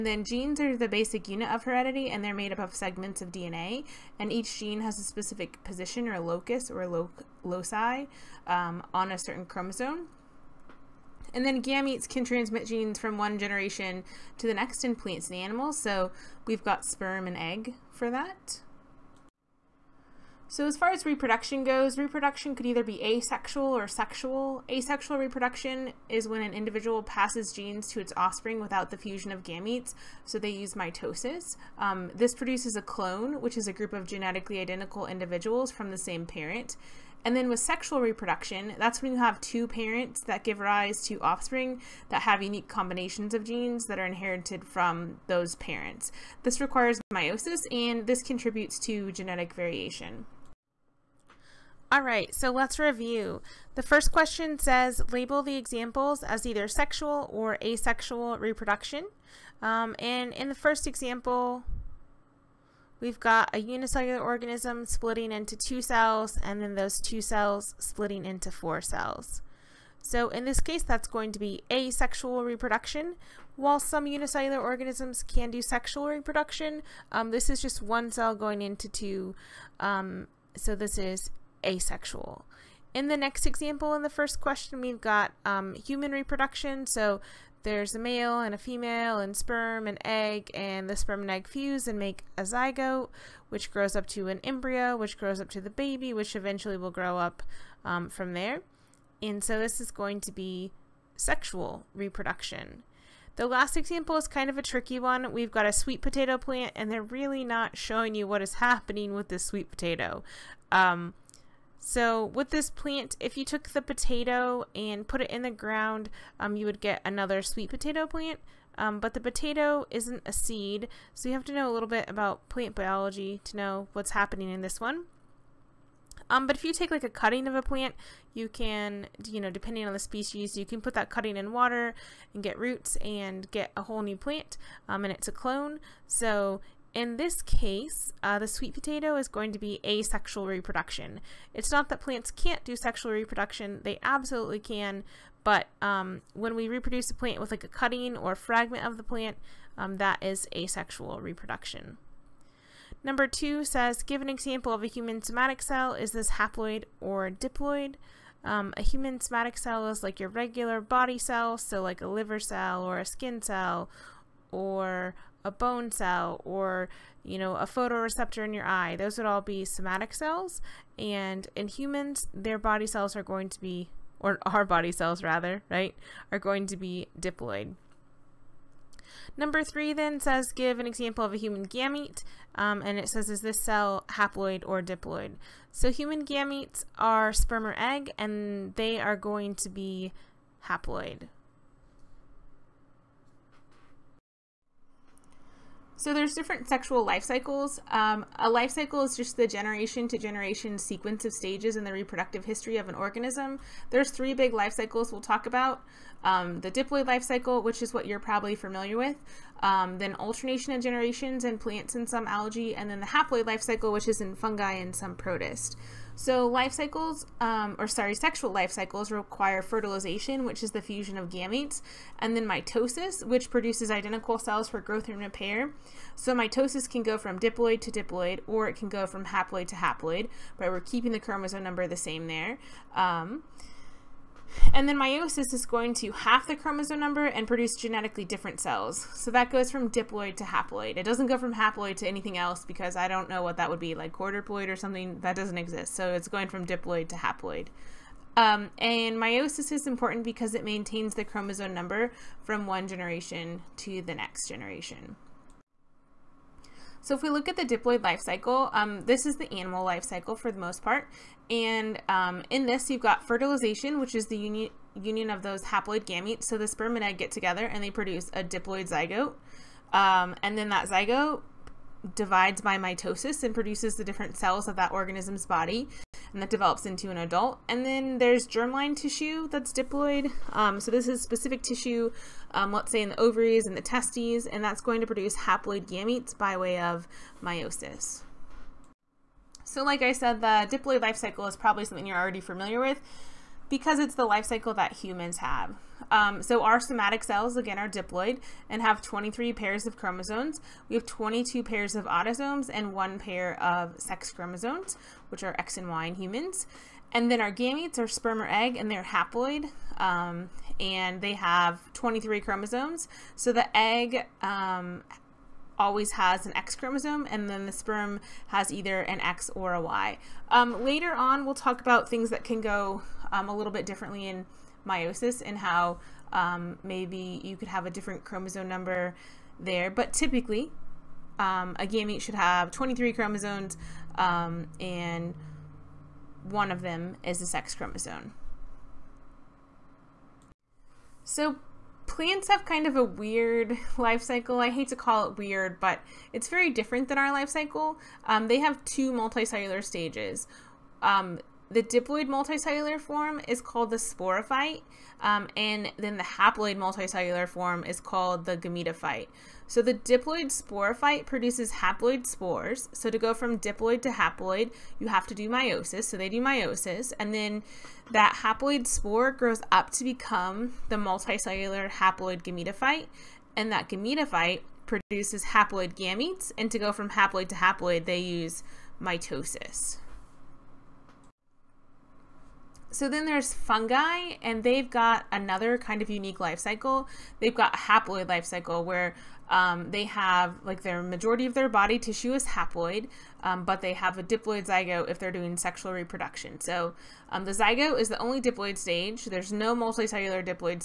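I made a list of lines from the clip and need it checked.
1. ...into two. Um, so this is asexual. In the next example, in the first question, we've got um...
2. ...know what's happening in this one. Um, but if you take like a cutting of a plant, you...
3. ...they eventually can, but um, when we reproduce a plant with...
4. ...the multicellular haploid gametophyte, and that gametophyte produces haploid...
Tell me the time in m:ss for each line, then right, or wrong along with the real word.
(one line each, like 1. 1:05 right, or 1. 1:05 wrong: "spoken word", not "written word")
1. 1:18 right
2. 2:03 right
3. 2:23 wrong: "absolutely", not "eventually"
4. 6:10 right.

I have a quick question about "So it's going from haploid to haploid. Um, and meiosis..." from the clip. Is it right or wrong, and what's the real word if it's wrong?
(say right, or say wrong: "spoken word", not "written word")
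wrong: "diploid", not "haploid".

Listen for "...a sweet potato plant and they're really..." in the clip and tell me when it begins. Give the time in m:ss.
1:45.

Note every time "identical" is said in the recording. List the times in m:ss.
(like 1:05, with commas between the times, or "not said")
0:34, 3:43.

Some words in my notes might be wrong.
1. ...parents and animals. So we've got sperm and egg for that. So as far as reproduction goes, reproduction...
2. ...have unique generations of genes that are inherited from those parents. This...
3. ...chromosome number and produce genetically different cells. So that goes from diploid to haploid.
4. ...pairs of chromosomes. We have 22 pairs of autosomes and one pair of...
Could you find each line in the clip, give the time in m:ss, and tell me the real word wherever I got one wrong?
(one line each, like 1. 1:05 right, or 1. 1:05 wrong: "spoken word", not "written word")
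1. 0:14 wrong: "plants", not "parents"
2. 0:42 wrong: "combinations", not "generations"
3. 3:56 right
4. 4:59 right.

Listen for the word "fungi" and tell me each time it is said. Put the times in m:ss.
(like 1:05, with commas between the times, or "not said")
3:34, 6:23.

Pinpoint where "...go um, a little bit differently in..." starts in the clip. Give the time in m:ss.
5:22.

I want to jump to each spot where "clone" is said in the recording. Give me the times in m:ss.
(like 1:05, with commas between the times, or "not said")
0:32, 2:15.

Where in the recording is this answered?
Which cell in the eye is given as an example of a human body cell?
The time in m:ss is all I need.
2:47.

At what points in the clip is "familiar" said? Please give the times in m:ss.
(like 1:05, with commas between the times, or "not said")
3:28, 4:52.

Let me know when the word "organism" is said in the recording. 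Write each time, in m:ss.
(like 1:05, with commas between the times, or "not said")
1:04, 1:14, 3:22, 4:34.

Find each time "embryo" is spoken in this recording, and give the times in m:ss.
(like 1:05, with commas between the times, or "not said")
1:34.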